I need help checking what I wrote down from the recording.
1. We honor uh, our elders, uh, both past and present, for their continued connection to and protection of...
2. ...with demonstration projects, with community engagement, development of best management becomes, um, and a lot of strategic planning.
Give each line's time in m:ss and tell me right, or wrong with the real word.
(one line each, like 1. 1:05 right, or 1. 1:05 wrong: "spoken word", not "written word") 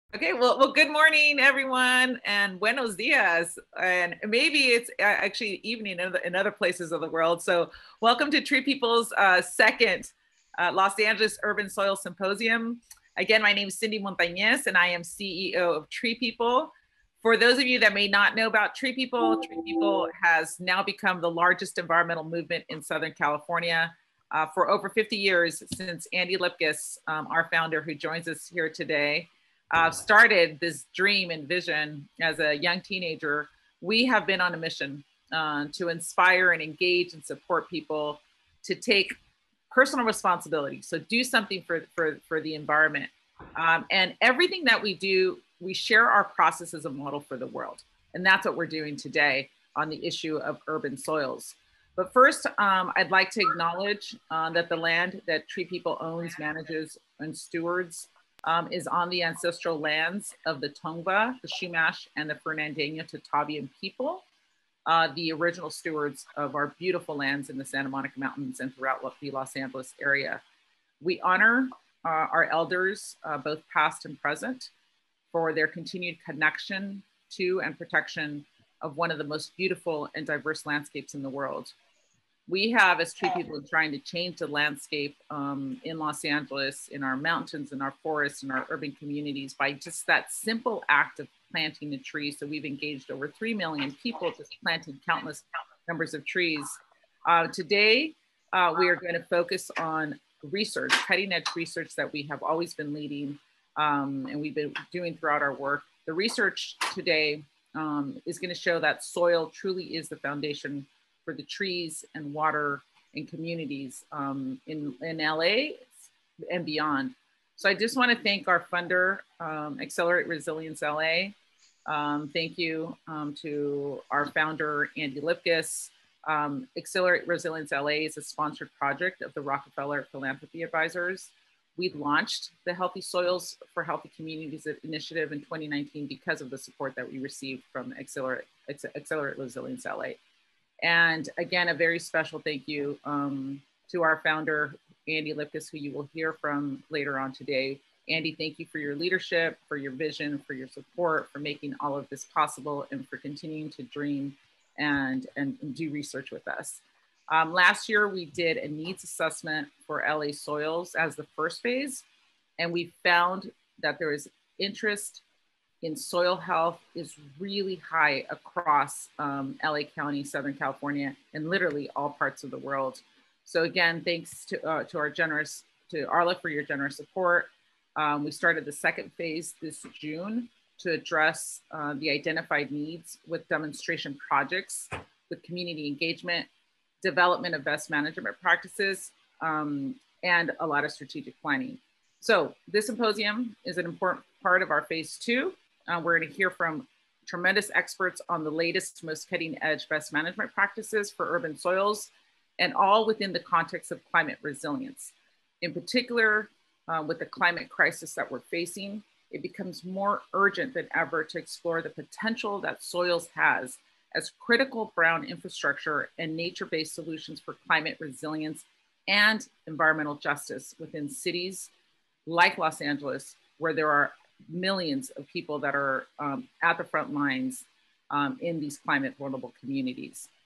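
1. 1:11 right
2. 3:03 wrong: "practices", not "becomes".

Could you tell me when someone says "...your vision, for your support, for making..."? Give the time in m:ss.
2:29.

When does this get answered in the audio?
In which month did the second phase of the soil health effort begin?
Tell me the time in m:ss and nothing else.
2:59.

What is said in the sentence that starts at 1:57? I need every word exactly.
So I just want to thank our funder, um, Accelerate Resilience LA.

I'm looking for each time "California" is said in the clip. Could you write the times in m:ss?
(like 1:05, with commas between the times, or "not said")
0:23, 2:50.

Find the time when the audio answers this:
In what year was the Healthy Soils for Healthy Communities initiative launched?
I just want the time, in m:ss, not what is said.
2:15.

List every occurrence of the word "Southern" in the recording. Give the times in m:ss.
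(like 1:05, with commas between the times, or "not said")
0:22, 2:50.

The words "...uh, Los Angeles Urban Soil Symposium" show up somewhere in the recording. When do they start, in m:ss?
0:10.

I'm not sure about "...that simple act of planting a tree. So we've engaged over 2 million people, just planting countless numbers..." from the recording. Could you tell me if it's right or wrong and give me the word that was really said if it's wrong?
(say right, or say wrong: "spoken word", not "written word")
wrong: "3", not "2".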